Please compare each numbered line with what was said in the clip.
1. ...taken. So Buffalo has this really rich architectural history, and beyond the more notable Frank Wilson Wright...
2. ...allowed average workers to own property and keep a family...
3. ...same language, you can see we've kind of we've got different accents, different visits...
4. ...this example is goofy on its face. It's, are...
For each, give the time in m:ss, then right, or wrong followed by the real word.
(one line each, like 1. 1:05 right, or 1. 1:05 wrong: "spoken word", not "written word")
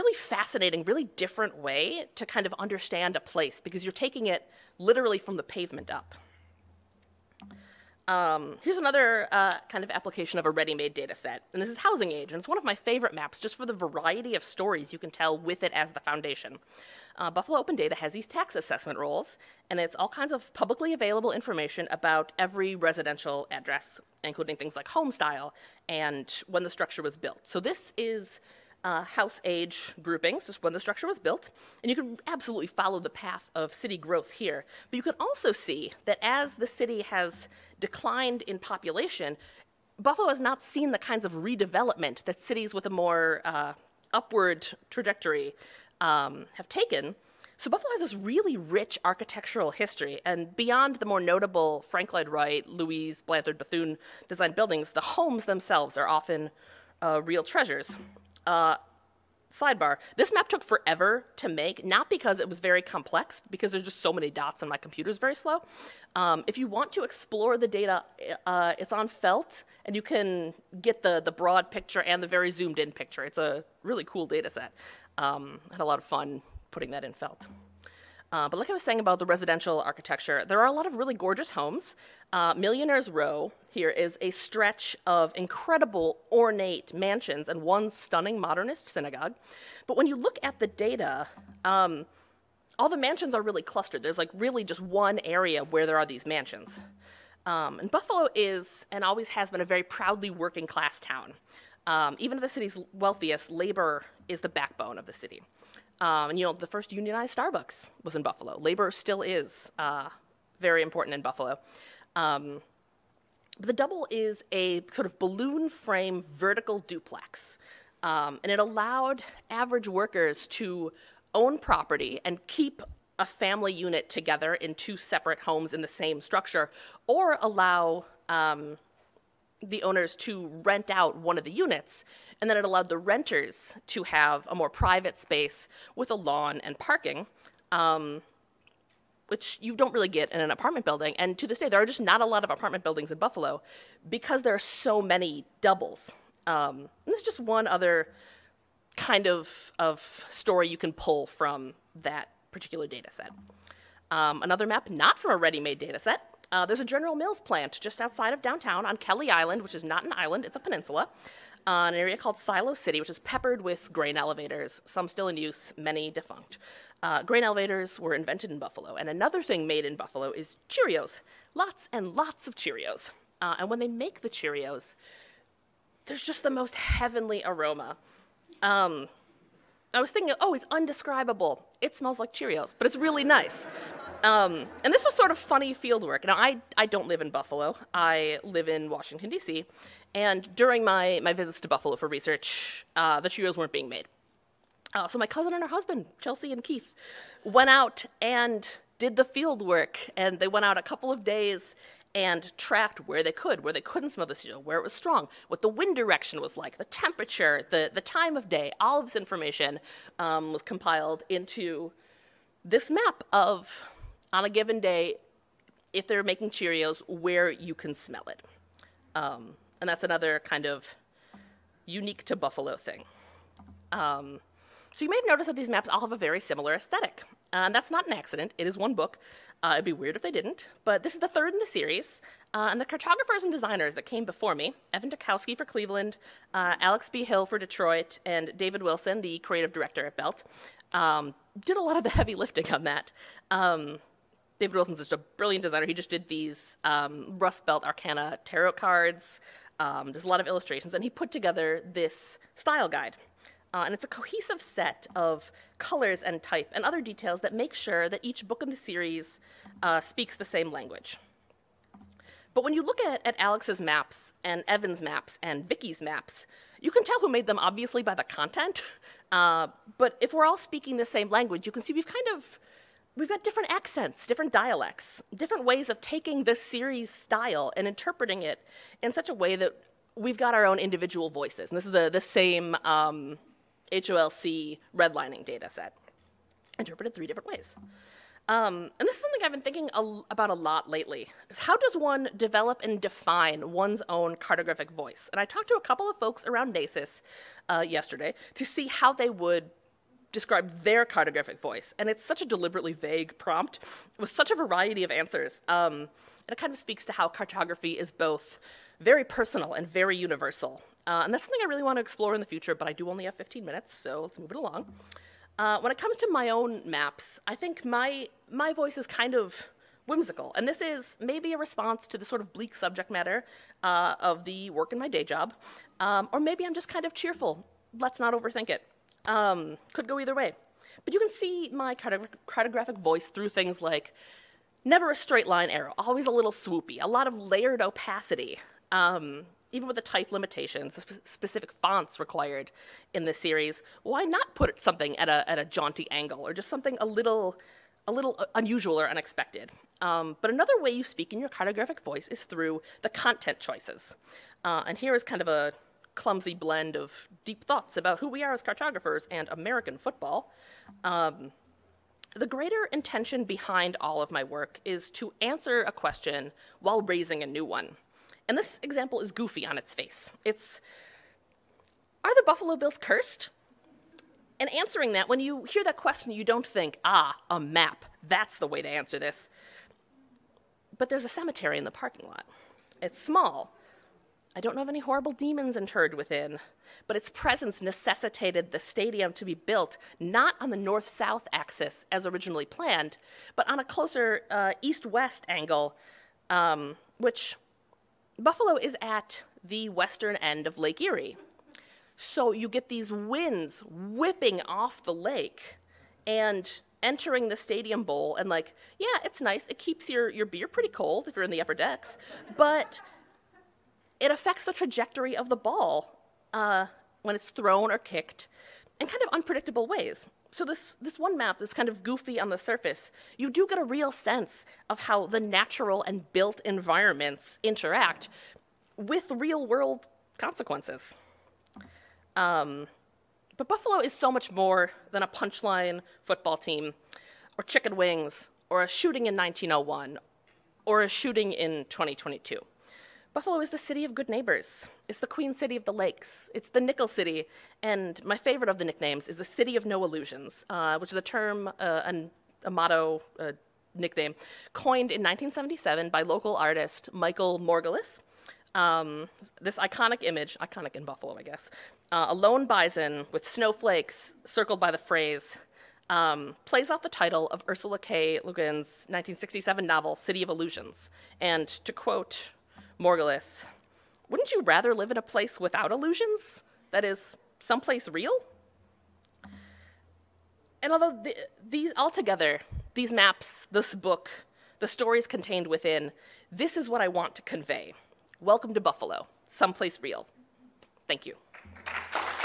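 1. 0:46 wrong: "Lloyd", not "Wilson"
2. 1:58 right
3. 4:31 wrong: "dialects", not "visits"
4. 6:08 right.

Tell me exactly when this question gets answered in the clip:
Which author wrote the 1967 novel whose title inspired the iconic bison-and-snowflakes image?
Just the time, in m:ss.
7:47.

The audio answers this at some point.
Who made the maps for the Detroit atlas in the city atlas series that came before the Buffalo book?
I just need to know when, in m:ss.
3:56.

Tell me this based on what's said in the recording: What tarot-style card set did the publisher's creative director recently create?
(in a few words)
Rust Belt Arcana.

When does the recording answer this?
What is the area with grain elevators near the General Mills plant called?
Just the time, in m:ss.
2:42.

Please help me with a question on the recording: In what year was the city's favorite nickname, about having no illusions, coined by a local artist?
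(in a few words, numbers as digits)
1977.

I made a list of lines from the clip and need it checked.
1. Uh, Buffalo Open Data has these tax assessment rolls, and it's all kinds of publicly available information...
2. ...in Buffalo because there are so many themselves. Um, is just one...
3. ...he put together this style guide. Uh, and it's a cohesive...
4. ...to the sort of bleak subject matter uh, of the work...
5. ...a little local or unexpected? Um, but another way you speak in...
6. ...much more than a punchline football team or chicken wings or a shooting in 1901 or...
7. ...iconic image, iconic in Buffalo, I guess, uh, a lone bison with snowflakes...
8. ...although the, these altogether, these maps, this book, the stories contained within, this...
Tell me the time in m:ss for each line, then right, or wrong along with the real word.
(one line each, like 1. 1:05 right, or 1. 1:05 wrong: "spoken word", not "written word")
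1. 0:17 right
2. 2:23 wrong: "doubles", not "themselves"
3. 4:11 right
4. 5:22 right
5. 5:48 wrong: "unusual", not "local"
6. 7:14 right
7. 7:39 right
8. 8:00 right.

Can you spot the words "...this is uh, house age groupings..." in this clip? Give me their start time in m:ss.
0:27.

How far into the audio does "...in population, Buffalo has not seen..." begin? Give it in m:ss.
0:38.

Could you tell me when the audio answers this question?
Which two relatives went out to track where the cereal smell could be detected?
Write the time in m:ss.
3:16.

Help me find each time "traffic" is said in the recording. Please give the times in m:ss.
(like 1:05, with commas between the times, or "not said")
not said.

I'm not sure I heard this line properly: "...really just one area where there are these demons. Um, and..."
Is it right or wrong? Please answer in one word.
wrong.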